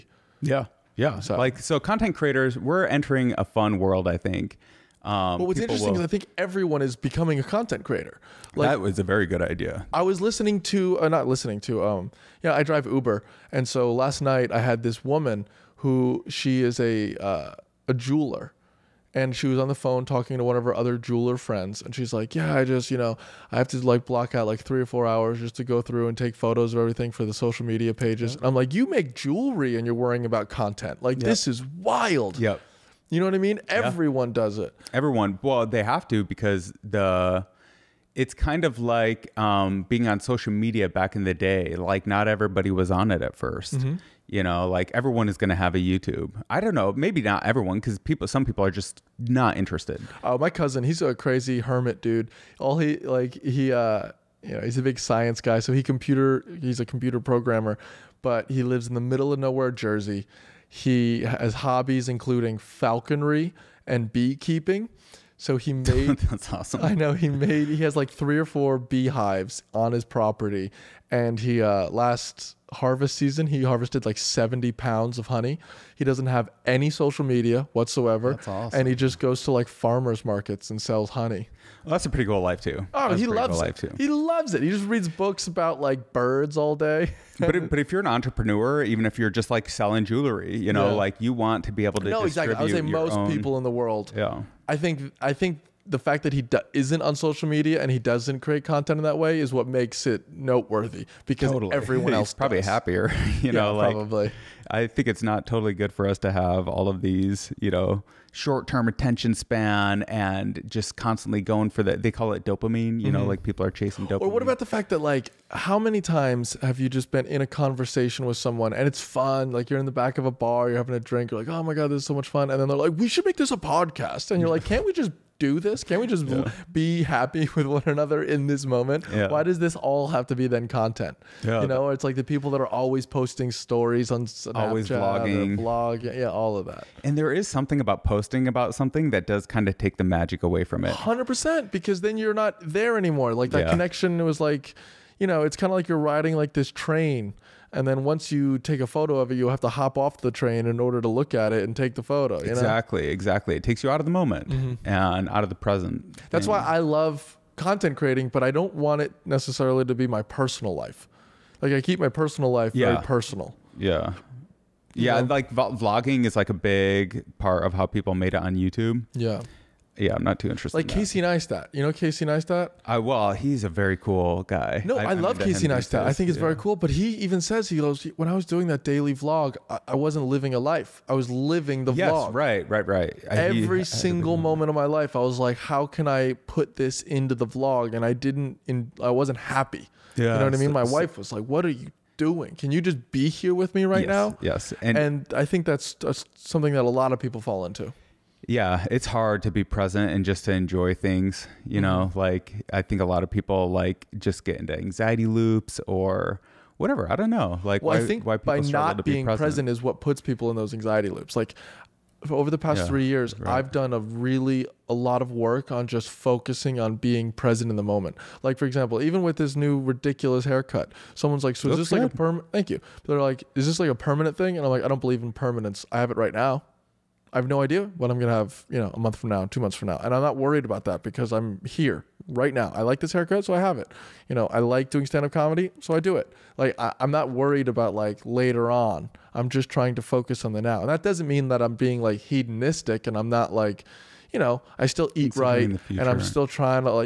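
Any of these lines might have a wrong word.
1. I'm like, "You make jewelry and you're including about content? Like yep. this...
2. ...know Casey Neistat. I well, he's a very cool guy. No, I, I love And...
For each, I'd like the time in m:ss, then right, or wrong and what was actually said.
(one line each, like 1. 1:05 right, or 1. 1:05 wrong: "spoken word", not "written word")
1. 0:28 wrong: "worrying", not "including"
2. 2:51 wrong: "Casey", not "And".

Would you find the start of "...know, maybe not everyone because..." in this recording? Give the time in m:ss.
0:46.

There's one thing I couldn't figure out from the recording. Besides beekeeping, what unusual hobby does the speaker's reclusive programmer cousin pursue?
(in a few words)
Falconry.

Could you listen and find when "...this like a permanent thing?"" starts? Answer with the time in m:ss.
3:43.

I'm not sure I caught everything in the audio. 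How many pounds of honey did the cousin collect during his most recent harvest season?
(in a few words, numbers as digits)
70.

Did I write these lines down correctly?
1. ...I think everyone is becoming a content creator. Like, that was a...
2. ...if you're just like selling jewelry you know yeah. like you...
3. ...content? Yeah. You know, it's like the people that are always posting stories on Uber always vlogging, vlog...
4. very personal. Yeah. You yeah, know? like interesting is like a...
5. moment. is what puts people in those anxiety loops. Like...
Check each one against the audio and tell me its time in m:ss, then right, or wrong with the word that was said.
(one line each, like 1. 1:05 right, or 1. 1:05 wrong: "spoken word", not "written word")
1. 0:06 right
2. 1:29 right
3. 2:10 wrong: "Snapchat", not "Uber"
4. 2:42 wrong: "vlogging", not "interesting"
5. 3:29 wrong: "present", not "moment".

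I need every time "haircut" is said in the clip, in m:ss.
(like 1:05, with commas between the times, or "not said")
3:40, 3:53.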